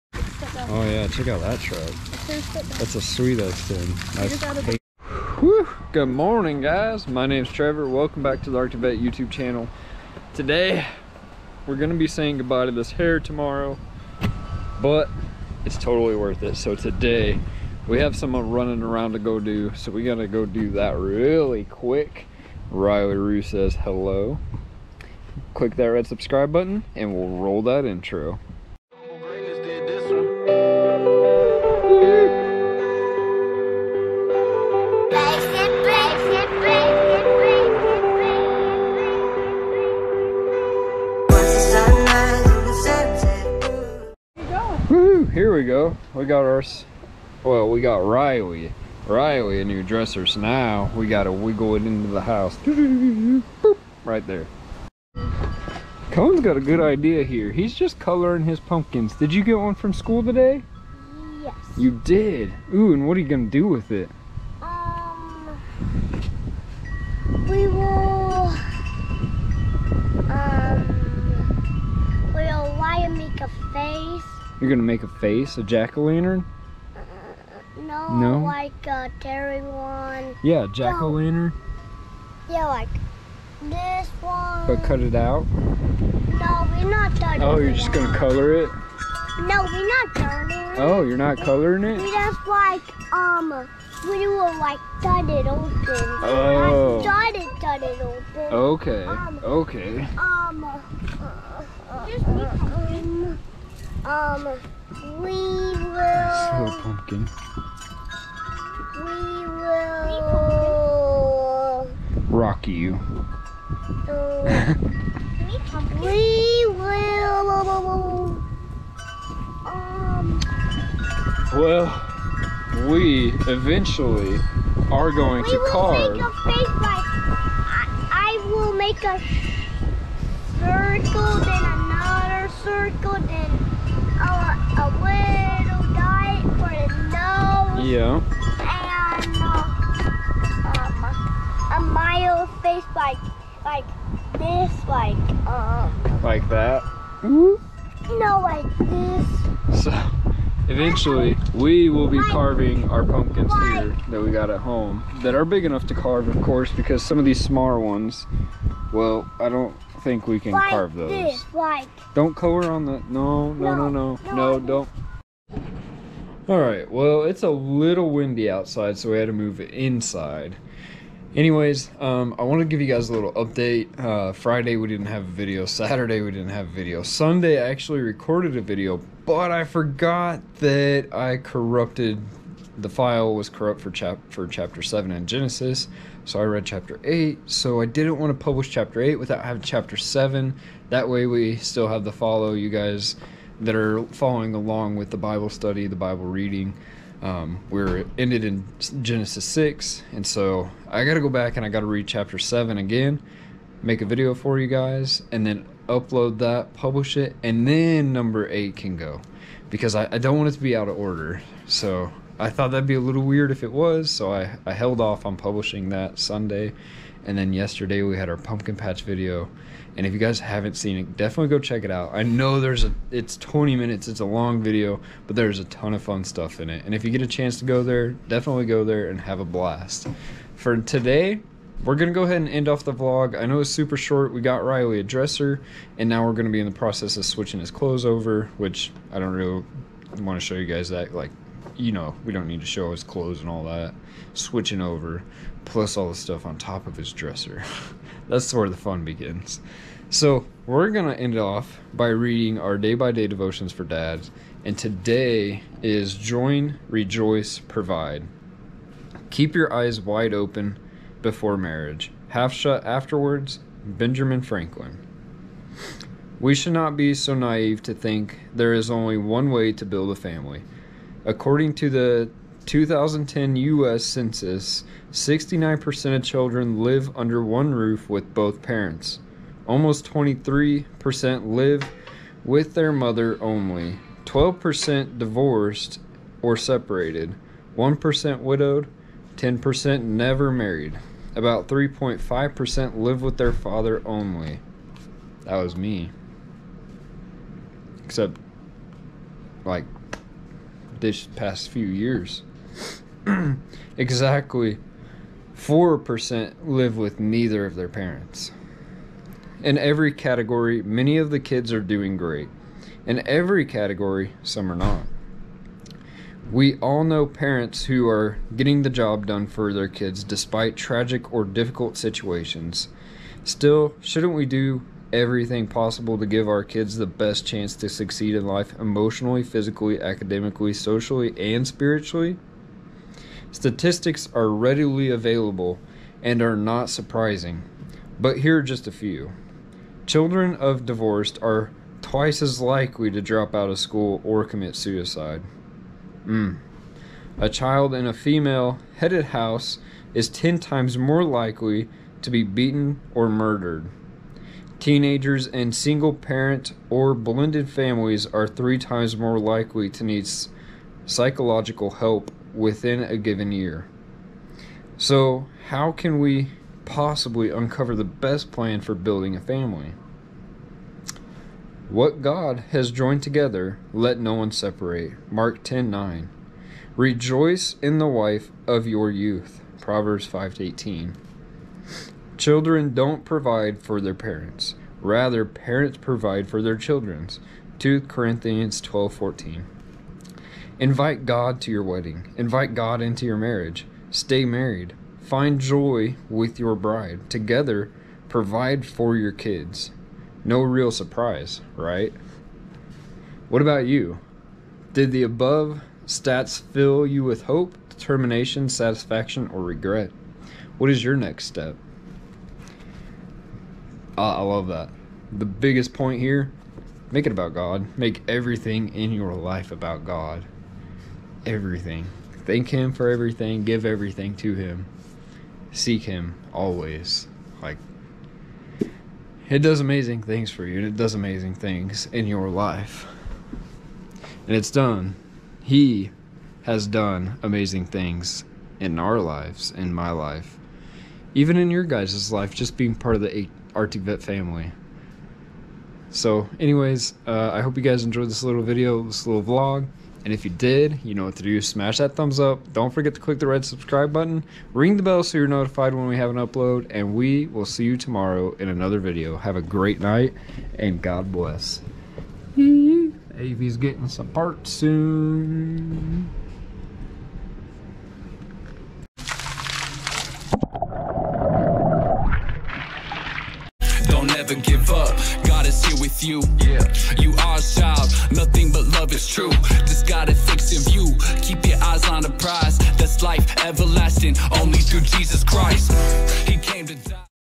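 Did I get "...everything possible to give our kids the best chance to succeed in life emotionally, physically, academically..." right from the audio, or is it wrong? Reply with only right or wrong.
right.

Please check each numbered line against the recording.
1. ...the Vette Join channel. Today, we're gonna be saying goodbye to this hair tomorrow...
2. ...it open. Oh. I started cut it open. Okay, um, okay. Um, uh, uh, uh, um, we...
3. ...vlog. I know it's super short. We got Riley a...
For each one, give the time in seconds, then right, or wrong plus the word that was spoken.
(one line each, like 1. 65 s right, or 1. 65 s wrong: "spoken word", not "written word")
1. 8 s wrong: "YouTube", not "Join"
2. 95 s right
3. 232 s right.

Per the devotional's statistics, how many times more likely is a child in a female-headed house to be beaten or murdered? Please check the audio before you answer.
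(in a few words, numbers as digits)
10 times.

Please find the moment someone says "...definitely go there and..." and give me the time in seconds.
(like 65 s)
228 s.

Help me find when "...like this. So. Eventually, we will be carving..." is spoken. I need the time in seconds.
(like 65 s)
148 s.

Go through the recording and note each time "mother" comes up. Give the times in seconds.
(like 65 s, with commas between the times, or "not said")
282 s.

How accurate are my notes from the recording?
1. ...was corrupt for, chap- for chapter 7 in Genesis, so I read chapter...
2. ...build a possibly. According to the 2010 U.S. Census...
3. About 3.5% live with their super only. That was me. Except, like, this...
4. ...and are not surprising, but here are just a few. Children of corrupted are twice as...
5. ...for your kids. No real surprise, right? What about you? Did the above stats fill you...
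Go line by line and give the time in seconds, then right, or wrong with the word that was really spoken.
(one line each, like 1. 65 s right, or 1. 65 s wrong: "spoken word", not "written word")
1. 183 s right
2. 269 s wrong: "family", not "possibly"
3. 291 s wrong: "father", not "super"
4. 336 s wrong: "divorced", not "corrupted"
5. 398 s right.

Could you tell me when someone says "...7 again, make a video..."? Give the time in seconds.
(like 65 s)
202 s.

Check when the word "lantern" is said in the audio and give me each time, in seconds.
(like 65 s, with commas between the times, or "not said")
75 s, 80 s.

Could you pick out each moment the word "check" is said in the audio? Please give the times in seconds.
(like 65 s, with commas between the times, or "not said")
1 s, 221 s.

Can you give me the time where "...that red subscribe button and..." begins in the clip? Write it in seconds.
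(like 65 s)
25 s.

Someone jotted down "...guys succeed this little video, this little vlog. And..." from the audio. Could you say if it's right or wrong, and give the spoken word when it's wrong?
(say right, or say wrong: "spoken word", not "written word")
wrong: "enjoyed", not "succeed".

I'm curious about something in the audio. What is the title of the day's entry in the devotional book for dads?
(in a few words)
Join, Rejoice, Provide.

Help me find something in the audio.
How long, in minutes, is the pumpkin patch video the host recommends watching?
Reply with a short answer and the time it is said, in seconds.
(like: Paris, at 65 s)
20 minutes, at 223 s.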